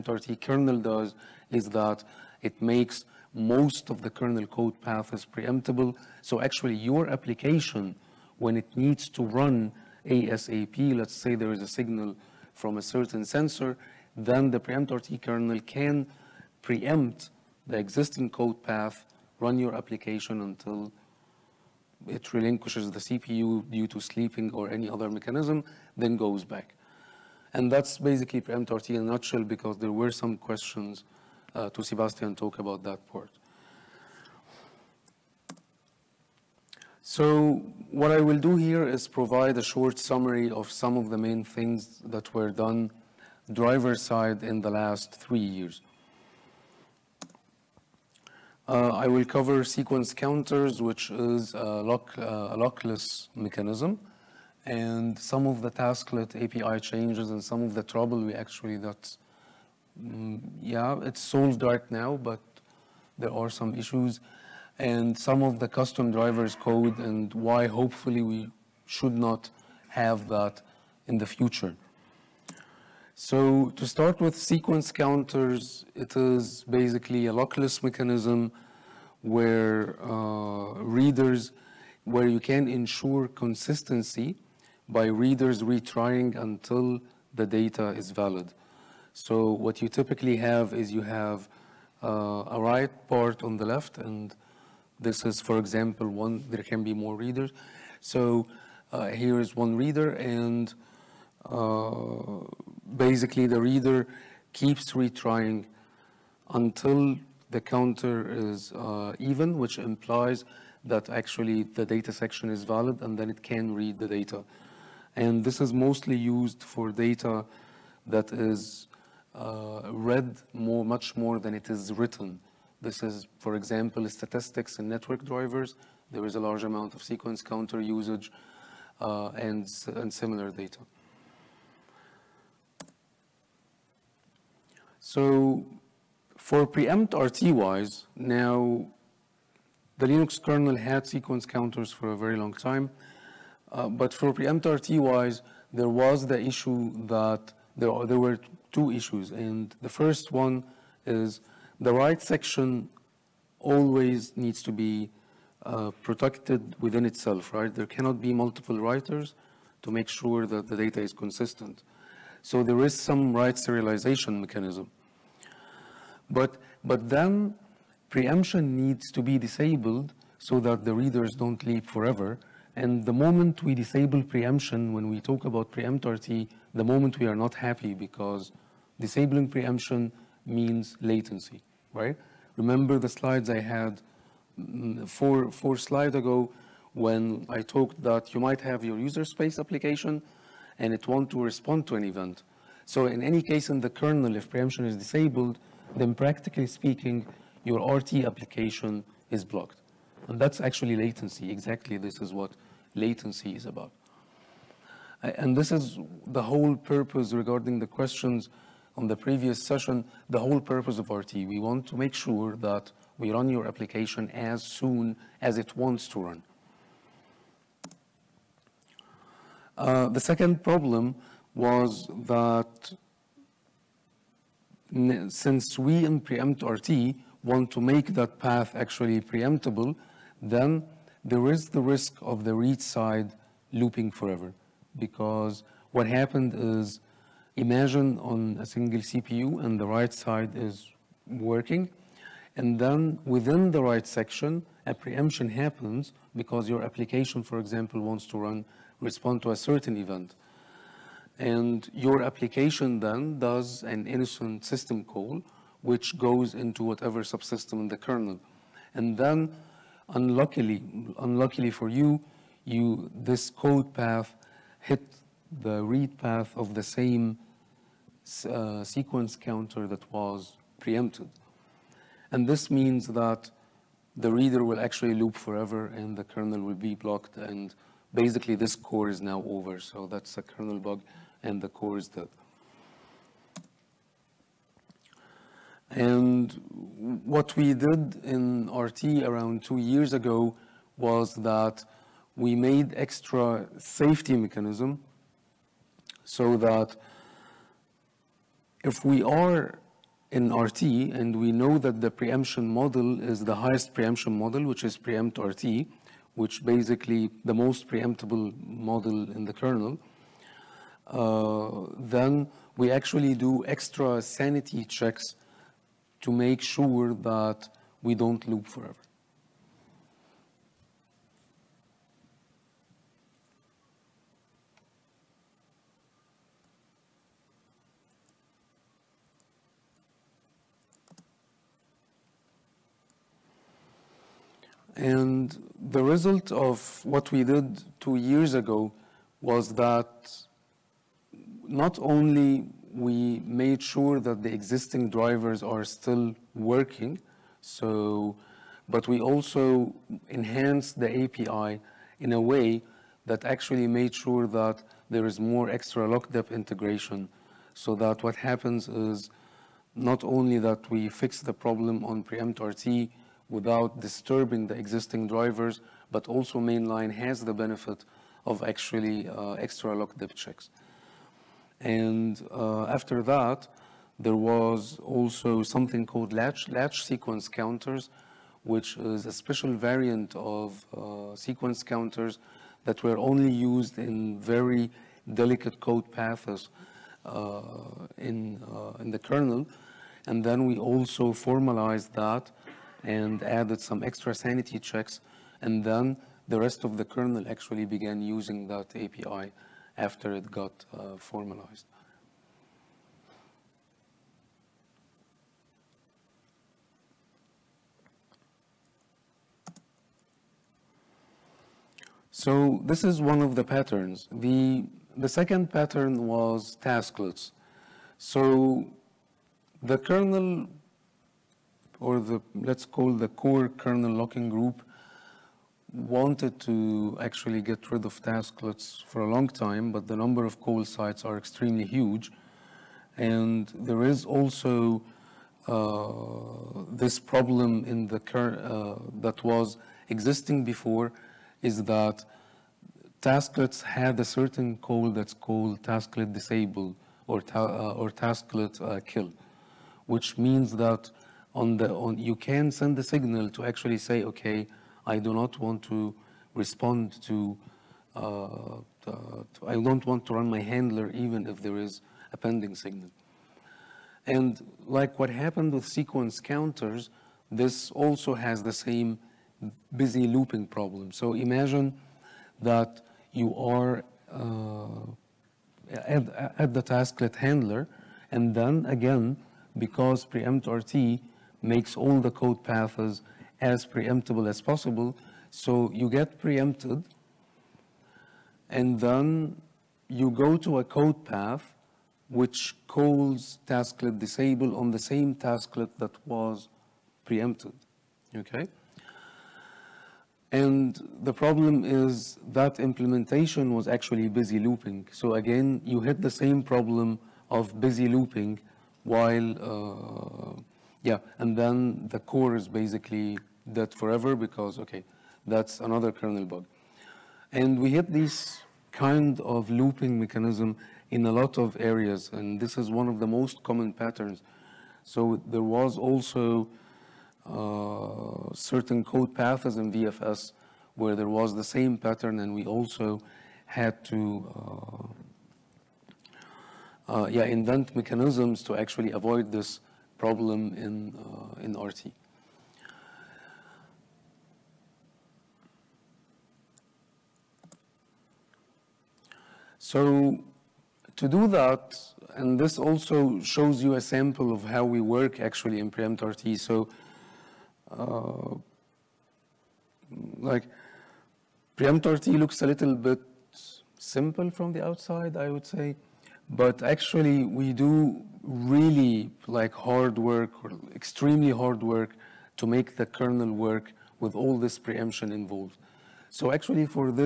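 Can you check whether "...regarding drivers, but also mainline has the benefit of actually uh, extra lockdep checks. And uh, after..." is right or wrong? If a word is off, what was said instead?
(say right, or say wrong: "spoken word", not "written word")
wrong: "existing", not "regarding".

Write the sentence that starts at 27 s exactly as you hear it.
And that's basically preempt RT in a nutshell because there were some questions uh, to Sebastian talk about that part.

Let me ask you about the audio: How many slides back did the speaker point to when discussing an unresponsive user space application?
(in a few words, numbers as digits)
4.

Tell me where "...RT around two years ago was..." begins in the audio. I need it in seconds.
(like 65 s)
288 s.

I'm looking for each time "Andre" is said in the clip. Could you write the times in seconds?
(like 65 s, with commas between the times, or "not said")
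not said.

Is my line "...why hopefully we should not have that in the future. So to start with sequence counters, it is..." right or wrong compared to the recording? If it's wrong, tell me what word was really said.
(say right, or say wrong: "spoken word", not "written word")
right.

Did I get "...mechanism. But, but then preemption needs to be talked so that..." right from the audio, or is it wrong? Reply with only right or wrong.
wrong.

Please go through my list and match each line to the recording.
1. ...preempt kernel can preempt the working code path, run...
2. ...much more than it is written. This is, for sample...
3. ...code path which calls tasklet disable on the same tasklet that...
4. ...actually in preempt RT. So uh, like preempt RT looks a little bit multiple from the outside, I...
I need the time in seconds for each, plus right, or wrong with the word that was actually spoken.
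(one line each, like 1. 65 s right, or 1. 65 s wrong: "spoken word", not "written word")
1. 14 s wrong: "existing", not "working"
2. 120 s wrong: "example", not "sample"
3. 490 s right
4. 555 s wrong: "simple", not "multiple".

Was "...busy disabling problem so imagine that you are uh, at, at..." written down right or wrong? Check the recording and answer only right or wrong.
wrong.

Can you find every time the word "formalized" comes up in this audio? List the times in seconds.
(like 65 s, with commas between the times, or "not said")
391 s, 401 s.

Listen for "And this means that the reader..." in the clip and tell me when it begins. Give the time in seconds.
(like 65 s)
272 s.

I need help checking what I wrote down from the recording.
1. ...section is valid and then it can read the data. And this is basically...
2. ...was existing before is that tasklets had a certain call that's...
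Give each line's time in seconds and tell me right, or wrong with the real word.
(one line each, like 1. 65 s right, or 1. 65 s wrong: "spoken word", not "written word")
1. 112 s wrong: "mostly", not "basically"
2. 439 s right.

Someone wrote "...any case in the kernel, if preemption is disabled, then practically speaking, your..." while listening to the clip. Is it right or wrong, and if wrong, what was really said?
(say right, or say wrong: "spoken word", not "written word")
right.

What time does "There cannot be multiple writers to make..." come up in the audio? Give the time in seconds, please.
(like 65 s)
157 s.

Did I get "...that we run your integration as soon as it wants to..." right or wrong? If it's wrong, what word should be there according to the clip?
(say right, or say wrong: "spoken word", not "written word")
wrong: "application", not "integration".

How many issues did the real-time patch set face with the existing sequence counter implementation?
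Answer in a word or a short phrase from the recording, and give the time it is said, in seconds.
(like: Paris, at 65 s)
2, at 148 s.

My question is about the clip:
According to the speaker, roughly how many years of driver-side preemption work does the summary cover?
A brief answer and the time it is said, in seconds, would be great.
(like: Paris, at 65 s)
3, at 45 s.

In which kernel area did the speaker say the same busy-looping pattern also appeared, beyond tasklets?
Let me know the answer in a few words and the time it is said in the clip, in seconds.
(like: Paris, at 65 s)
VFS, at 529 s.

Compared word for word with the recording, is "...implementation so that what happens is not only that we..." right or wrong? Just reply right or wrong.
wrong.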